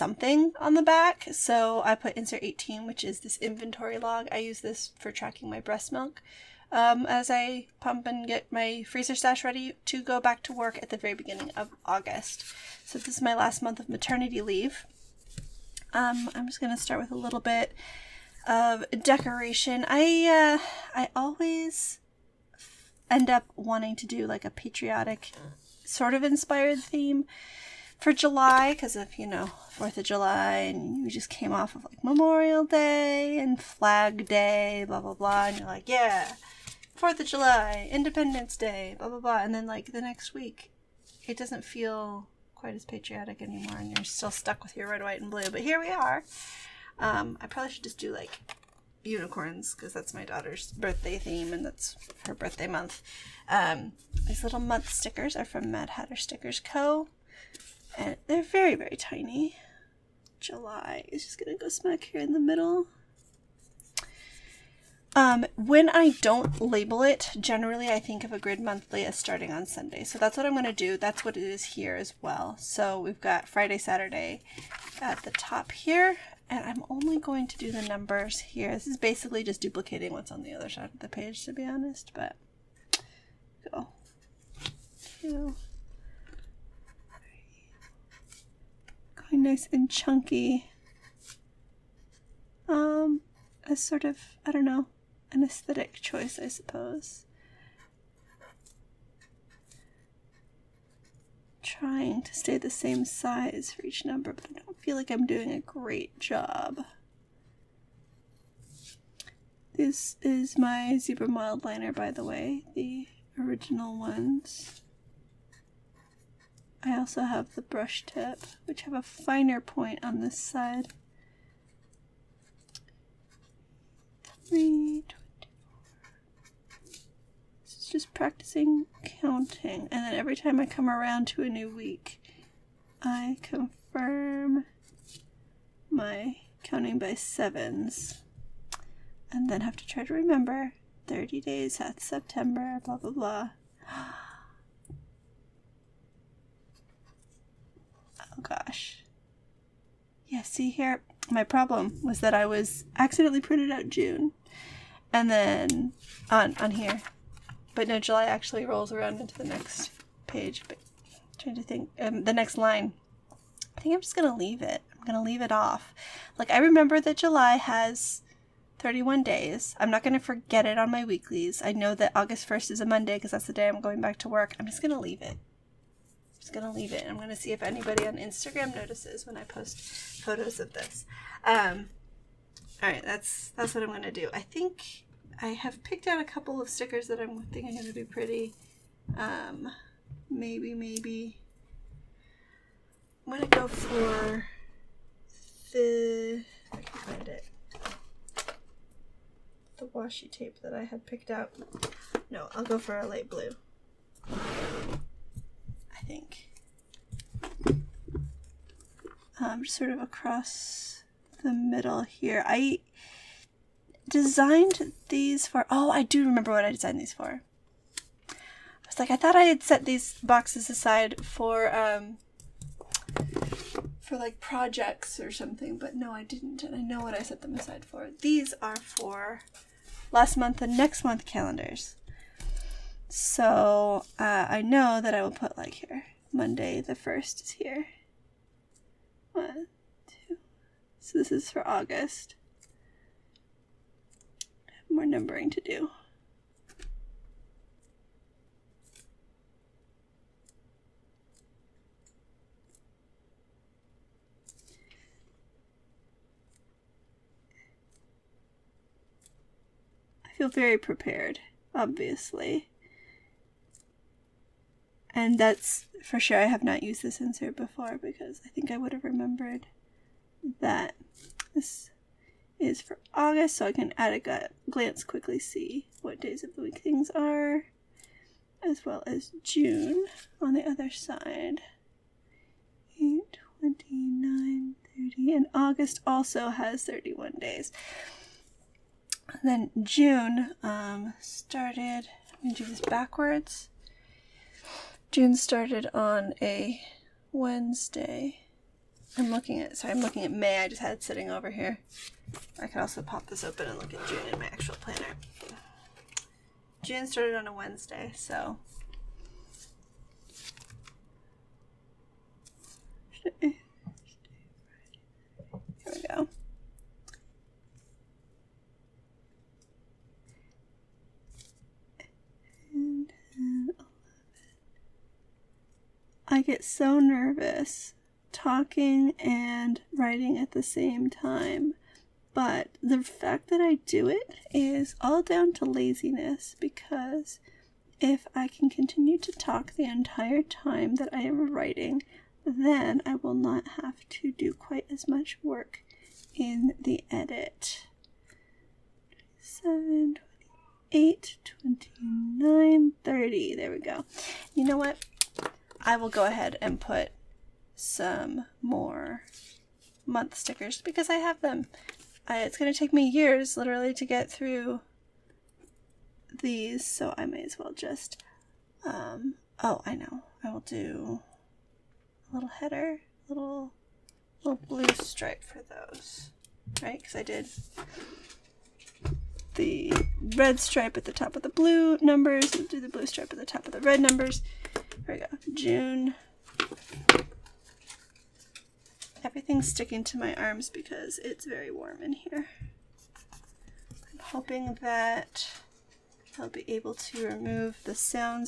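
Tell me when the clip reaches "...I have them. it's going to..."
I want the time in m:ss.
6:01.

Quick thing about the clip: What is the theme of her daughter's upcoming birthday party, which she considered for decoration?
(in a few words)
unicorns.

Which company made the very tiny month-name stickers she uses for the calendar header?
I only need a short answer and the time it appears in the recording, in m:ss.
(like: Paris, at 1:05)
Mad Hatter Stickers Co., at 0:55.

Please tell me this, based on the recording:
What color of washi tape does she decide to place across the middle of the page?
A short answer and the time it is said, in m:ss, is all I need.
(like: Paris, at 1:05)
light blue, at 3:23.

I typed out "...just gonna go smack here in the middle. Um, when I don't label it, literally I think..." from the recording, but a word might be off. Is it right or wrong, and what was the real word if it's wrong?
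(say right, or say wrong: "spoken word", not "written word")
wrong: "generally", not "literally".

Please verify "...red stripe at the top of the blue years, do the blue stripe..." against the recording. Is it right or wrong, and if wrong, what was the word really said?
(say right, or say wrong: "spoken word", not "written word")
wrong: "numbers", not "years".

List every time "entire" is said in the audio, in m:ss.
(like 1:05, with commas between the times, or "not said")
5:39.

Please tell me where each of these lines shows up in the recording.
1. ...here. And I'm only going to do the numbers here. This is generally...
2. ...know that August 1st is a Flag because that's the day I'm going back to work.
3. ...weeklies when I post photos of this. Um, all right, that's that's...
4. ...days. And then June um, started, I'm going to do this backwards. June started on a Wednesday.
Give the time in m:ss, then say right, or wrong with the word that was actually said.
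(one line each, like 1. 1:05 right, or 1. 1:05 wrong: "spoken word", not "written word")
1. 1:15 wrong: "basically", not "generally"
2. 2:51 wrong: "Monday", not "Flag"
3. 2:58 wrong: "notices", not "weeklies"
4. 4:47 right.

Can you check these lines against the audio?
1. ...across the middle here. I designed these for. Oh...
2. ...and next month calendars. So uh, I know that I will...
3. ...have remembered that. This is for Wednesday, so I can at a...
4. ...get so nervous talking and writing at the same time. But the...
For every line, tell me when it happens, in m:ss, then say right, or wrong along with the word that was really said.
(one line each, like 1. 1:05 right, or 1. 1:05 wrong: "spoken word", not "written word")
1. 3:30 right
2. 3:50 right
3. 4:28 wrong: "August", not "Wednesday"
4. 5:26 right.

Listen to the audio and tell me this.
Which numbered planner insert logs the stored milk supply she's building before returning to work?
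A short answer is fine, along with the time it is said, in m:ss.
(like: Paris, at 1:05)
18, at 0:02.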